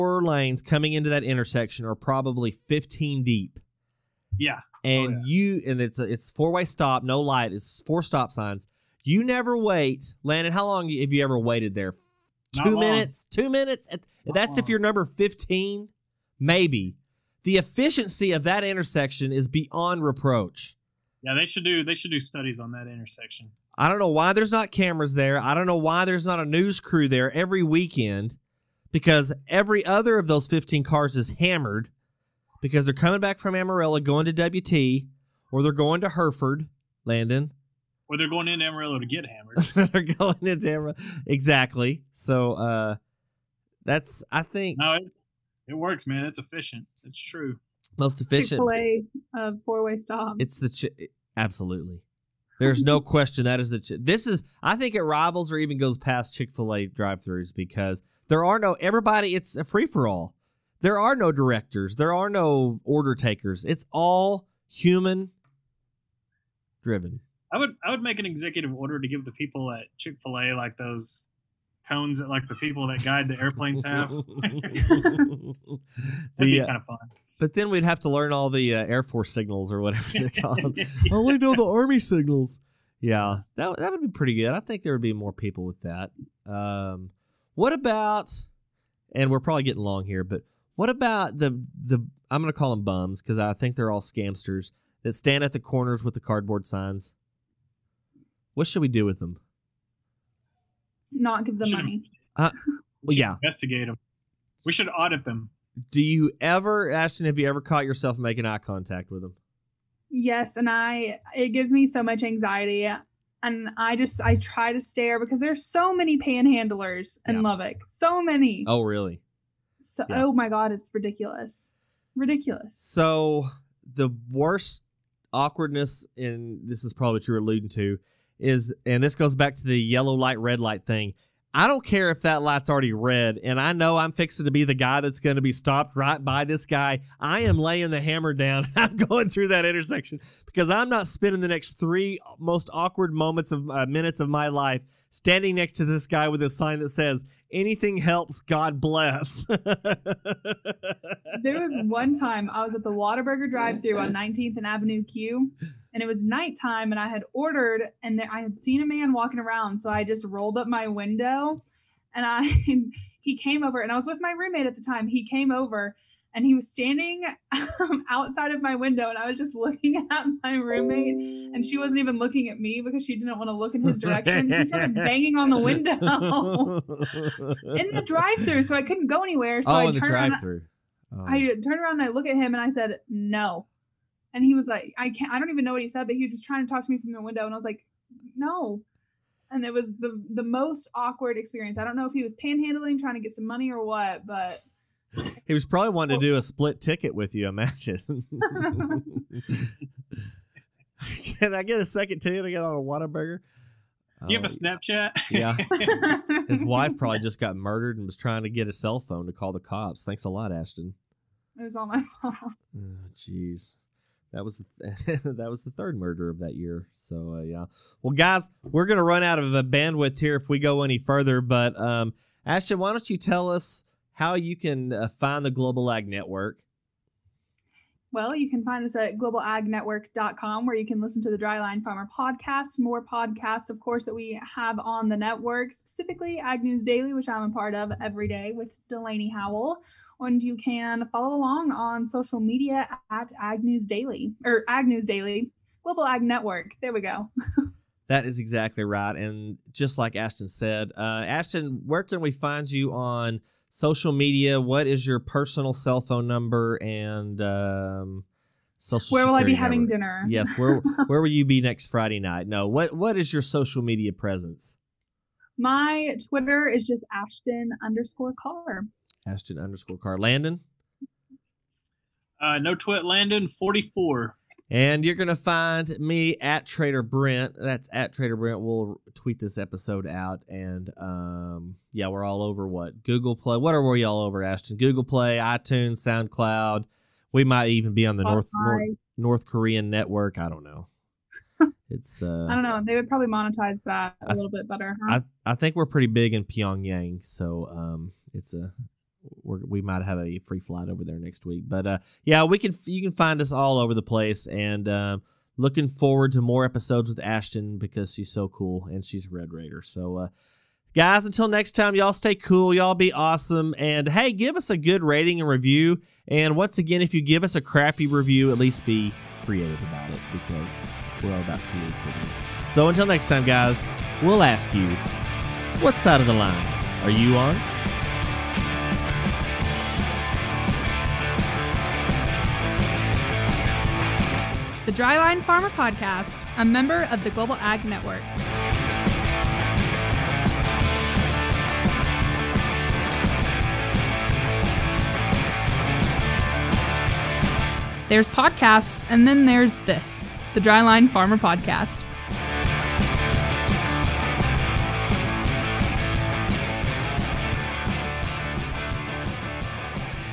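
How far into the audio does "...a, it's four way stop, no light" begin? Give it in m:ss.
0:05.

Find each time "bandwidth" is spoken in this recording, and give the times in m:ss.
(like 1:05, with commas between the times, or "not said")
3:39.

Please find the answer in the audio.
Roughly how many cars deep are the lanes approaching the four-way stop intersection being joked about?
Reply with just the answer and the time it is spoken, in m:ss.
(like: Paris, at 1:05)
15, at 0:02.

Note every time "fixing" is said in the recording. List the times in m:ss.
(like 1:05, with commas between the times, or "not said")
2:14.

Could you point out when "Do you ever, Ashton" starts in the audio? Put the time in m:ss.
1:45.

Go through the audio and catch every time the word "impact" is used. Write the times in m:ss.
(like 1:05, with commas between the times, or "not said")
not said.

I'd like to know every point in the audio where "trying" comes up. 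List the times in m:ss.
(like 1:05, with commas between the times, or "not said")
3:06, 3:12, 3:28.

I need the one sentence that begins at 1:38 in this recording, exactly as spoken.
What should we do with them?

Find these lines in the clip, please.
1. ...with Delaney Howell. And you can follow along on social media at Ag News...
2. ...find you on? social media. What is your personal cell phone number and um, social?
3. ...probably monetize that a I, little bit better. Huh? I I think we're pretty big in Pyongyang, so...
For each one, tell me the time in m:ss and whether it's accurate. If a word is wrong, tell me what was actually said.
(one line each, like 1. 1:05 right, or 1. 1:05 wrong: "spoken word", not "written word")
1. 3:58 right
2. 4:12 right
3. 4:53 right.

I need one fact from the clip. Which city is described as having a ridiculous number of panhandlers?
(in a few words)
Lubbock.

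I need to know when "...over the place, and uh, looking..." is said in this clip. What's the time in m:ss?
5:03.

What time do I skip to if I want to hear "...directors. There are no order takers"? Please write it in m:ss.
1:01.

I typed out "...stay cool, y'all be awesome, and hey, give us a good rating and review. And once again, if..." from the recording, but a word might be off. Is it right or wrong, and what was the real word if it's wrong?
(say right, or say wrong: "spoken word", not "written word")
right.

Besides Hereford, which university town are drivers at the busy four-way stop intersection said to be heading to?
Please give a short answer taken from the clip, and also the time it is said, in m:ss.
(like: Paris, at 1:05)
WT, at 0:34.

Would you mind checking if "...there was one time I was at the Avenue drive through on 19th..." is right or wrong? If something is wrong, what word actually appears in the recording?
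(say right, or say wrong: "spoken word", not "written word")
wrong: "Whataburger", not "Avenue".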